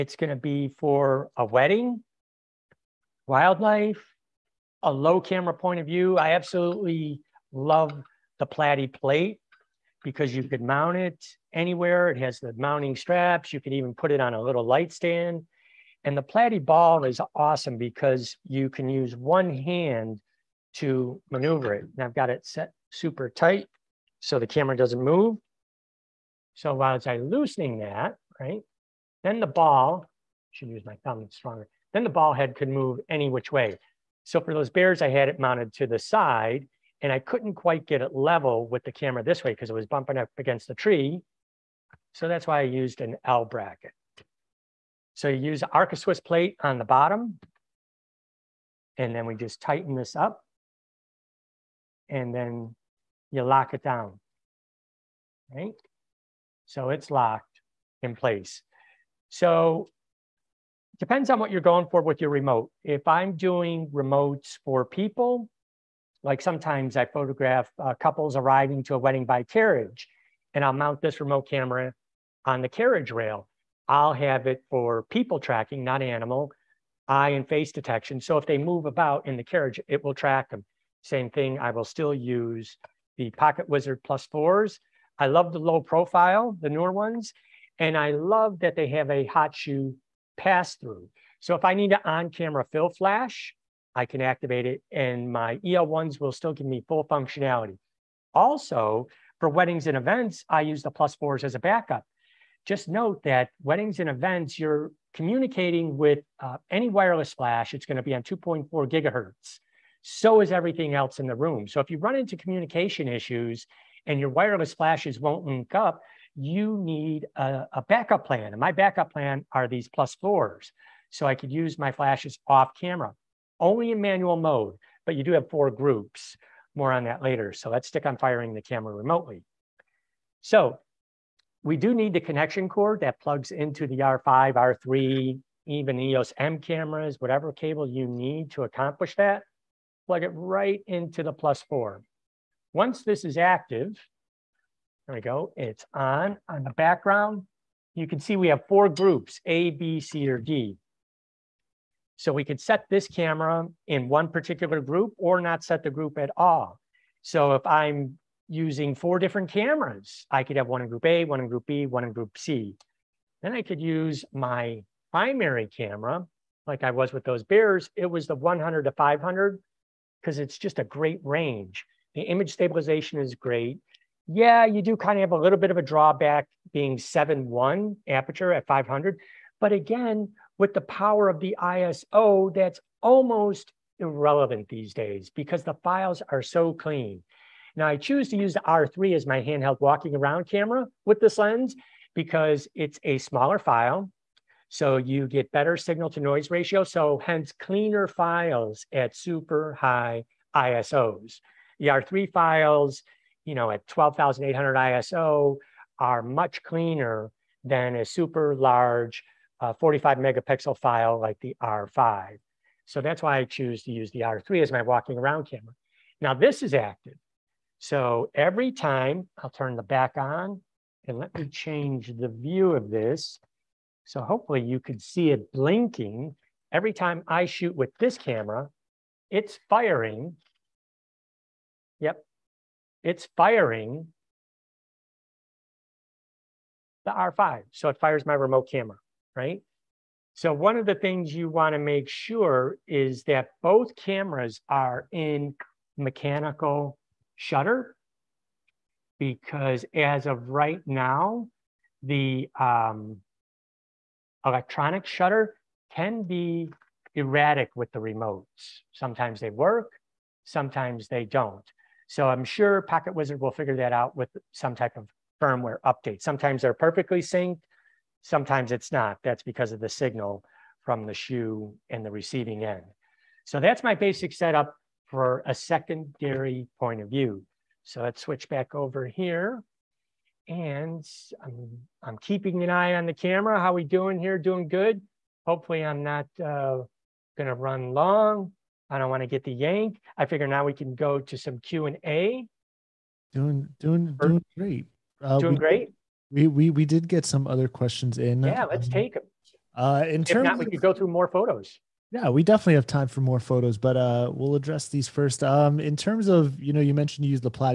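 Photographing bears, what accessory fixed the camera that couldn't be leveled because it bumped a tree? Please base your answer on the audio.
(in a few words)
L bracket.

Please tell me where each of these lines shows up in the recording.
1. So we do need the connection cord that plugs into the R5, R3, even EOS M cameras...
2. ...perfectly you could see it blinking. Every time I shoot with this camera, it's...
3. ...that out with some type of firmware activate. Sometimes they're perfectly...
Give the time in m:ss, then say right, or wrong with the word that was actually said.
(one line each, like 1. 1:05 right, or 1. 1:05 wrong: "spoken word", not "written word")
1. 2:10 right
2. 3:44 wrong: "hopefully", not "perfectly"
3. 4:23 wrong: "update", not "activate".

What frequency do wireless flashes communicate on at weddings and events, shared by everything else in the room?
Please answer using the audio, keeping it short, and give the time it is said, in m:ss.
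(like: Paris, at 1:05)
2.4 gigahertz, at 1:48.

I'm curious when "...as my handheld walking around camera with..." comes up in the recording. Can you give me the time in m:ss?
3:09.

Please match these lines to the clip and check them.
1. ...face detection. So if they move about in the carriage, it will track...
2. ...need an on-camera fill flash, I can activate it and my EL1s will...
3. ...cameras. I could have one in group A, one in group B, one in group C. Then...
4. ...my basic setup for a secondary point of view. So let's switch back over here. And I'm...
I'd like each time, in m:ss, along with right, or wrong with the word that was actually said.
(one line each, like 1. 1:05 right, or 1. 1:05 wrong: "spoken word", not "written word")
1. 1:17 right
2. 1:31 right
3. 2:39 right
4. 4:33 right.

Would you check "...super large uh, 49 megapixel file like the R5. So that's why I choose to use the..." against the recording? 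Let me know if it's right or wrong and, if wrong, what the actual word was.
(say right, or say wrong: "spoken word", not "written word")
wrong: "45", not "49".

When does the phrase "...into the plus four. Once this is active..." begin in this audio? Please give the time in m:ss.
2:20.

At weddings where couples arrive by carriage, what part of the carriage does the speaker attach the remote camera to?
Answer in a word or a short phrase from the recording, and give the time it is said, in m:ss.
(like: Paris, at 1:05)
the carriage rail, at 1:12.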